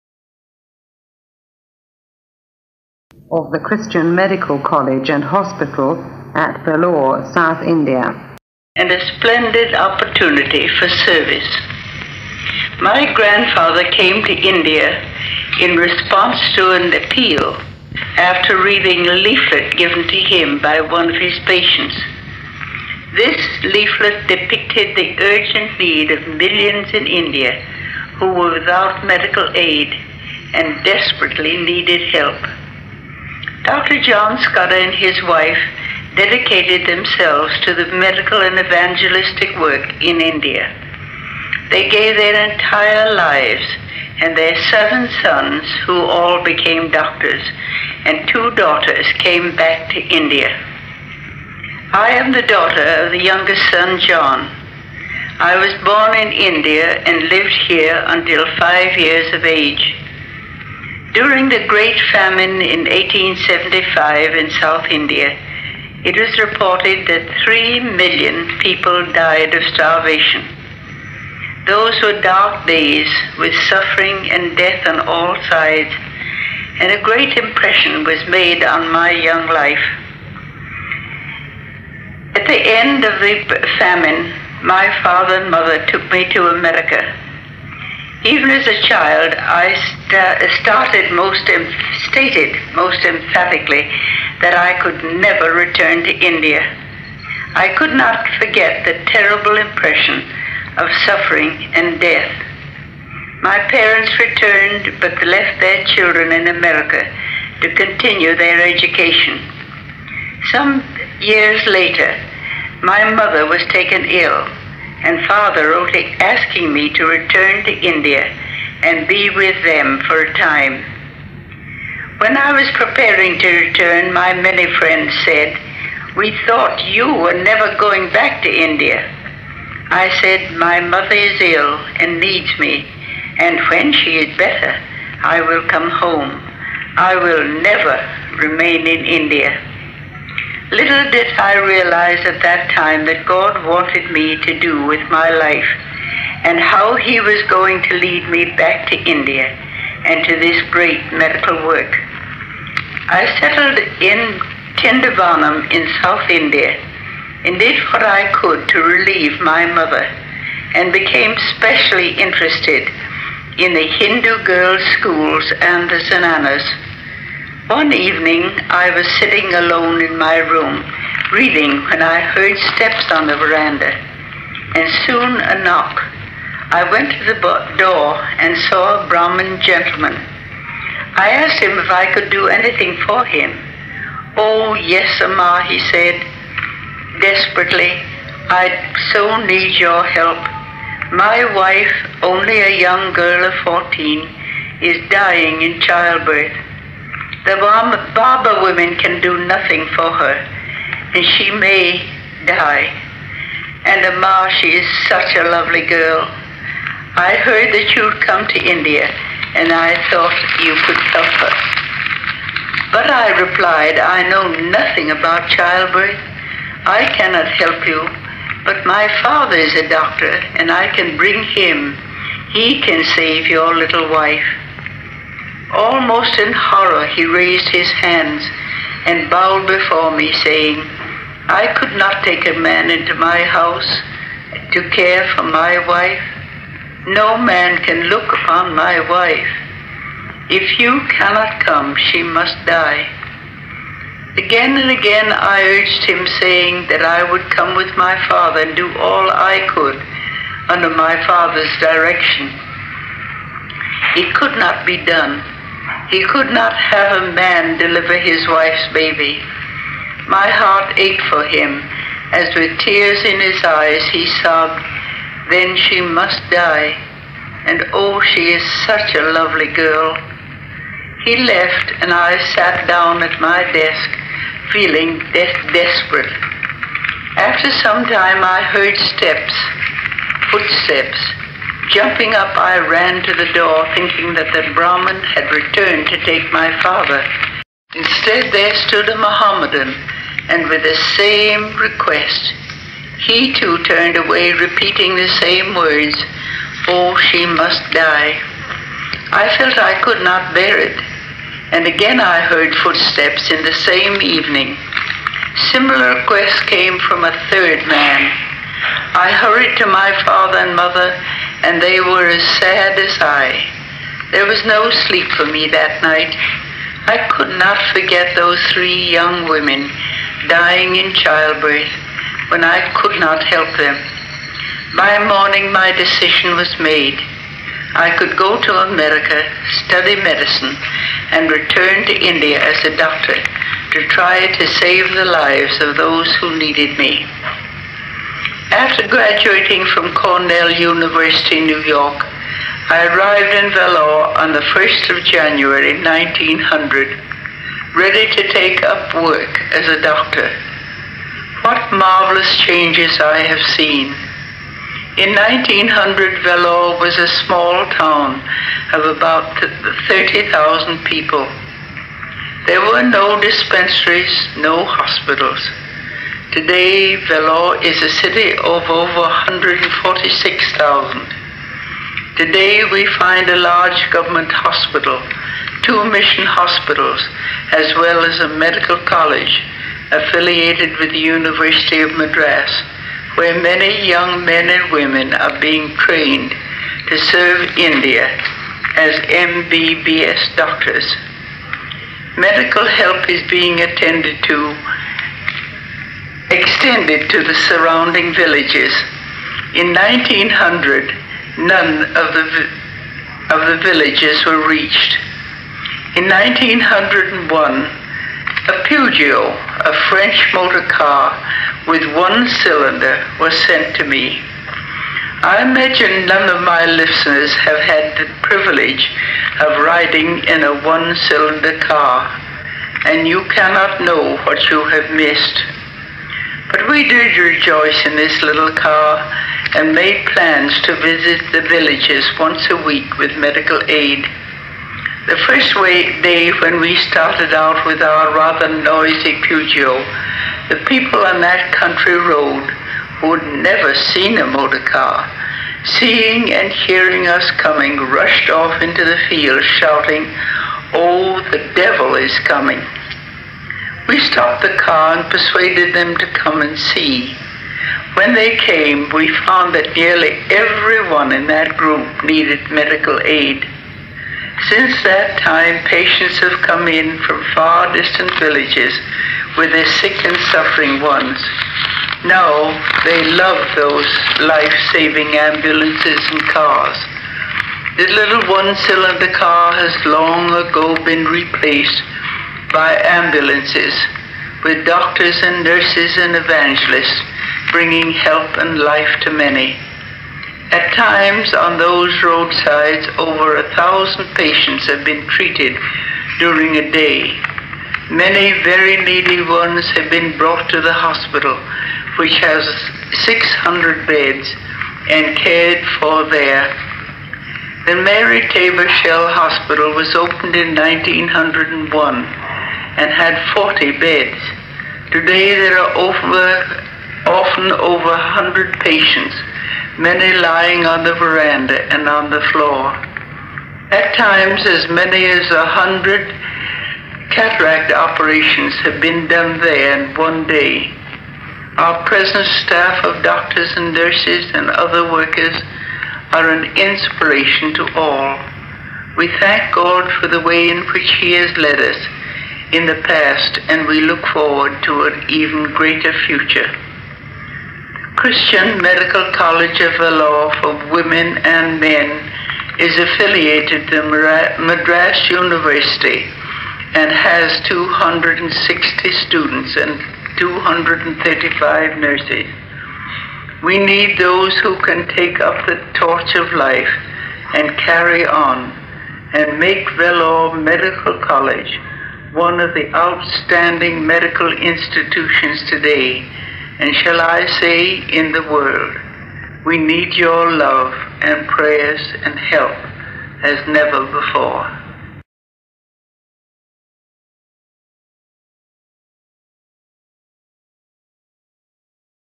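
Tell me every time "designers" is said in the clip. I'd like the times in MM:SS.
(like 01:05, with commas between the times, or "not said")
not said.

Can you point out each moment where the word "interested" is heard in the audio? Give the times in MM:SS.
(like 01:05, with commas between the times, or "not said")
02:42.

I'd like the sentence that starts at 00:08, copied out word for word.
And a splendid opportunity for service.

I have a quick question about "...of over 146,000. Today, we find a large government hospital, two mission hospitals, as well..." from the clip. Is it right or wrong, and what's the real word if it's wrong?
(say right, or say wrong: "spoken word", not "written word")
right.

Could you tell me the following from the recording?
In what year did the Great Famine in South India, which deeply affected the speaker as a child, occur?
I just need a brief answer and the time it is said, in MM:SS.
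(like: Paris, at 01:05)
1875, at 01:02.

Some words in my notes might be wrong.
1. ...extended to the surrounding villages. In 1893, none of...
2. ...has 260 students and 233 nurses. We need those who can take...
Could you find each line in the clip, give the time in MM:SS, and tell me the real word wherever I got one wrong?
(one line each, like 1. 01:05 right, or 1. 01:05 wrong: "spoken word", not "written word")
1. 06:36 wrong: "1900", not "1893"
2. 09:17 wrong: "235", not "233".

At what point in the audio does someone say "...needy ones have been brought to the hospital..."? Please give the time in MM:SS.
08:19.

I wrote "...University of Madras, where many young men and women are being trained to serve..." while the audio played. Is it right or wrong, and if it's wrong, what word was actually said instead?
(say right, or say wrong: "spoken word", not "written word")
right.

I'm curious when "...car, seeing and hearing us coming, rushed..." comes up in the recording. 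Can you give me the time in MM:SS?
07:24.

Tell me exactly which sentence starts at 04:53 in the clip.
He too turned away, repeating the same words, Oh, she must die.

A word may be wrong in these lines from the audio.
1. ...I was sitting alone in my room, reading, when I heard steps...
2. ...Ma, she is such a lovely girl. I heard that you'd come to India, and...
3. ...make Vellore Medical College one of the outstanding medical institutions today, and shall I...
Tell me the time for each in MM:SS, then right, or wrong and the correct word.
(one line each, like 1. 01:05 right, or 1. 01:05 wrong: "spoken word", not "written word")
1. 02:48 right
2. 03:24 right
3. 09:29 right.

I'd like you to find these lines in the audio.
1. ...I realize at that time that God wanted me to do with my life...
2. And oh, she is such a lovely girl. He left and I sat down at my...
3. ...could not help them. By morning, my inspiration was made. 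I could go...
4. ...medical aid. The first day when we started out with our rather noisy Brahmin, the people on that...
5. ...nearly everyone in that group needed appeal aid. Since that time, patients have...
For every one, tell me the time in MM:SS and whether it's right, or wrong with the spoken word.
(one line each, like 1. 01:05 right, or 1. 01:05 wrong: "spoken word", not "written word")
1. 02:21 right
2. 04:27 right
3. 05:22 wrong: "decision", not "inspiration"
4. 07:13 wrong: "Peugeot", not "Brahmin"
5. 07:39 wrong: "medical", not "appeal".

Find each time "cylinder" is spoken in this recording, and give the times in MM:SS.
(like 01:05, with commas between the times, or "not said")
06:52, 07:01, 07:58.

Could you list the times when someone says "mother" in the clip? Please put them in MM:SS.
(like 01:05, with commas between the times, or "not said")
01:25, 01:53, 02:10, 02:39, 05:10.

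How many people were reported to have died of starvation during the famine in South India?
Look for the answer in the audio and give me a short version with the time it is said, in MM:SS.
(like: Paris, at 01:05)
3 million, at 01:07.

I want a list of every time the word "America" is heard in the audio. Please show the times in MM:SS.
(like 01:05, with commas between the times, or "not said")
01:26, 01:46, 05:28.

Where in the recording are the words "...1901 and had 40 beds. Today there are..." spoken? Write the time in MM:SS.
08:30.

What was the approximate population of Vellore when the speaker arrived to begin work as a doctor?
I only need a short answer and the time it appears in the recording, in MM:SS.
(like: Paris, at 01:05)
30,000, at 06:00.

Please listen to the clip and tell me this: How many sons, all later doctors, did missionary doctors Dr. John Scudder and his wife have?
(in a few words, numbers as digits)
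7.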